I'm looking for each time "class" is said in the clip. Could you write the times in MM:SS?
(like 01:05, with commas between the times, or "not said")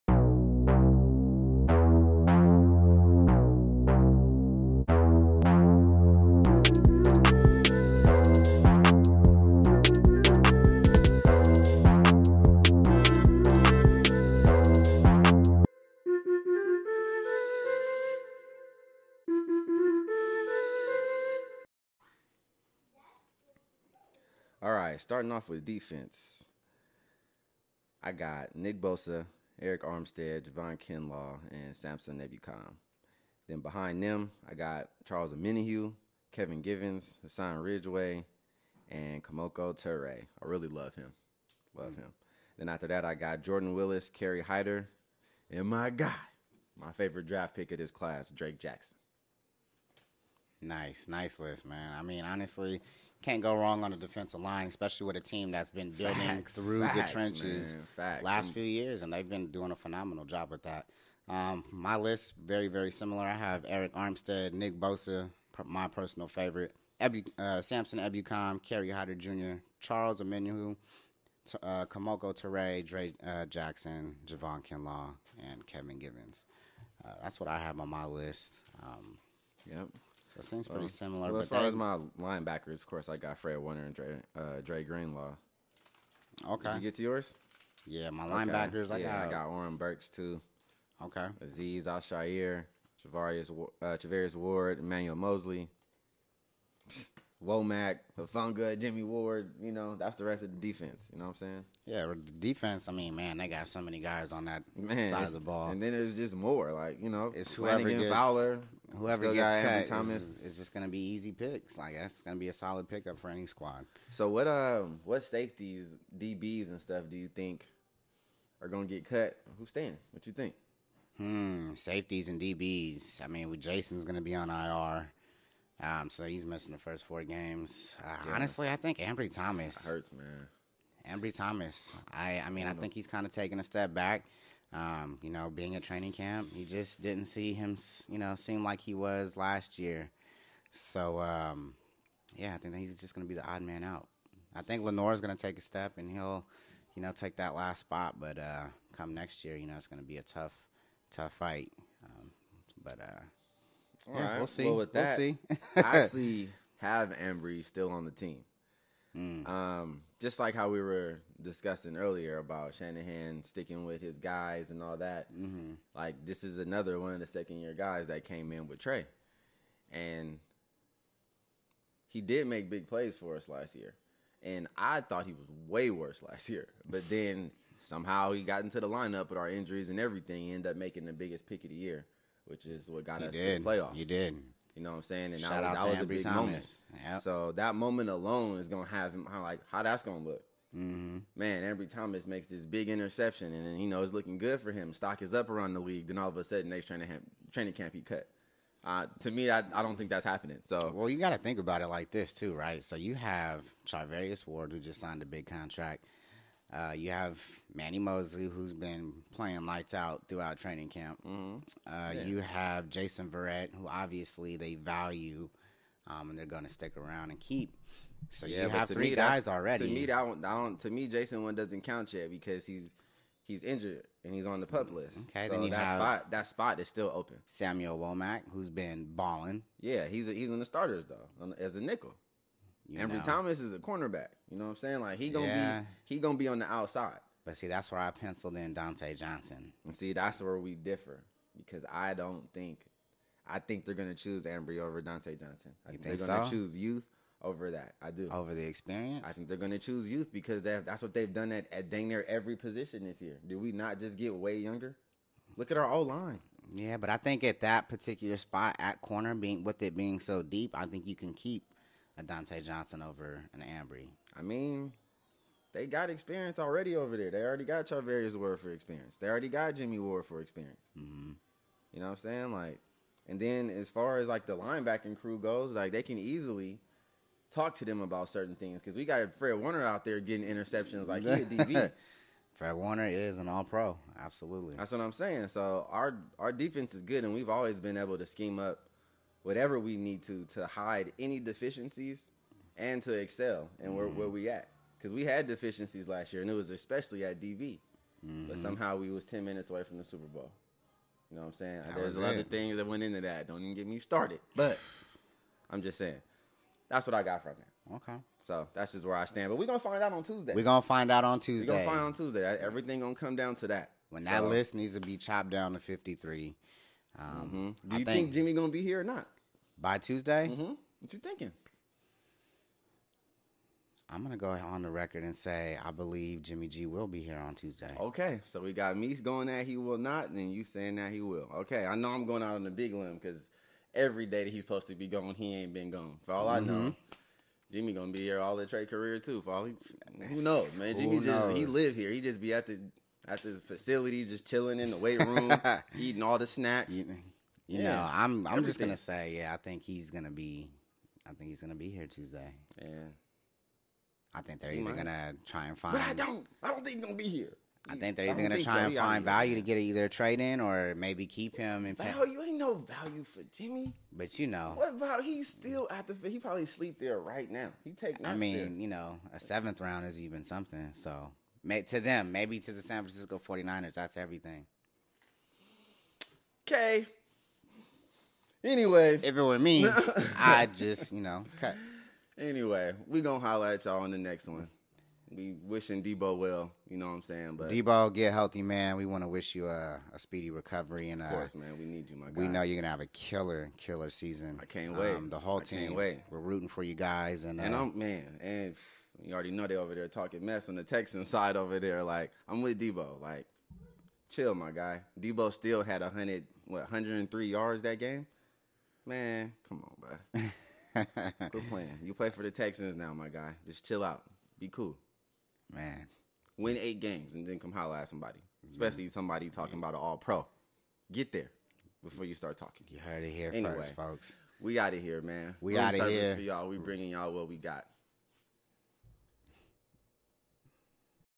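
00:47.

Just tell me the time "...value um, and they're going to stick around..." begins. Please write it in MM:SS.
03:34.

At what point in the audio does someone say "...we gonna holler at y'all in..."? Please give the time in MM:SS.
06:23.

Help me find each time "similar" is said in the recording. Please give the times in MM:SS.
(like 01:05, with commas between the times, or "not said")
01:02, 01:20.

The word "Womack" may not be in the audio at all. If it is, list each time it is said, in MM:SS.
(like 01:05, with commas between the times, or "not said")
01:37, 03:47.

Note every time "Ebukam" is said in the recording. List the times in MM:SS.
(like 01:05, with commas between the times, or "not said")
00:32, 01:07.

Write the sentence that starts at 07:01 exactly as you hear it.
Get there before you start talking.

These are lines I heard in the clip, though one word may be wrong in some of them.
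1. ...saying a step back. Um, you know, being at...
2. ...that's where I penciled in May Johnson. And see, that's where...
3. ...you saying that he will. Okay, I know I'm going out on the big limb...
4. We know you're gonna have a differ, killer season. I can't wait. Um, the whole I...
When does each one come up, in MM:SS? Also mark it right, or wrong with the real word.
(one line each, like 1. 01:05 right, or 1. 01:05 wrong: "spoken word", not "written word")
1. 02:13 wrong: "taking", not "saying"
2. 03:57 wrong: "Dontae", not "May"
3. 05:30 right
4. 06:32 wrong: "killer", not "differ".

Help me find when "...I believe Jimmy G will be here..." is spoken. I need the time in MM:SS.
05:25.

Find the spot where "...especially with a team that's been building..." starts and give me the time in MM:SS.
00:54.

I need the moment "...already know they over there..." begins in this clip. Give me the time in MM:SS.
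06:39.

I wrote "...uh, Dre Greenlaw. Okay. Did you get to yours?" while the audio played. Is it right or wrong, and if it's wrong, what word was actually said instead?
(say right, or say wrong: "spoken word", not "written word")
right.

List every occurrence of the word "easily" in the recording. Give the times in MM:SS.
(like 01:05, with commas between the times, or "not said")
04:36.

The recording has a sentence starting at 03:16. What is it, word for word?
Then all of a sudden, next training camp, training camp he cut.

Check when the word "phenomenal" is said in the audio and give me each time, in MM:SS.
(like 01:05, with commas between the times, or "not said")
00:59.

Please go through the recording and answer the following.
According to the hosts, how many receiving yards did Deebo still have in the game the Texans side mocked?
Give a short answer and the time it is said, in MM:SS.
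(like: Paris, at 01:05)
103, at 06:46.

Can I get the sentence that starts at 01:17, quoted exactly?
Uh, that's what I have on my list.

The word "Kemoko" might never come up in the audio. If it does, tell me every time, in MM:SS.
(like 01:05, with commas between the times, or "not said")
00:39, 01:11.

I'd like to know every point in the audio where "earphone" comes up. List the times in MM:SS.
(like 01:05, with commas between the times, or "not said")
not said.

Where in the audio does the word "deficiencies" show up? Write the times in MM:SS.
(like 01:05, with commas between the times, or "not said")
04:51, 04:55.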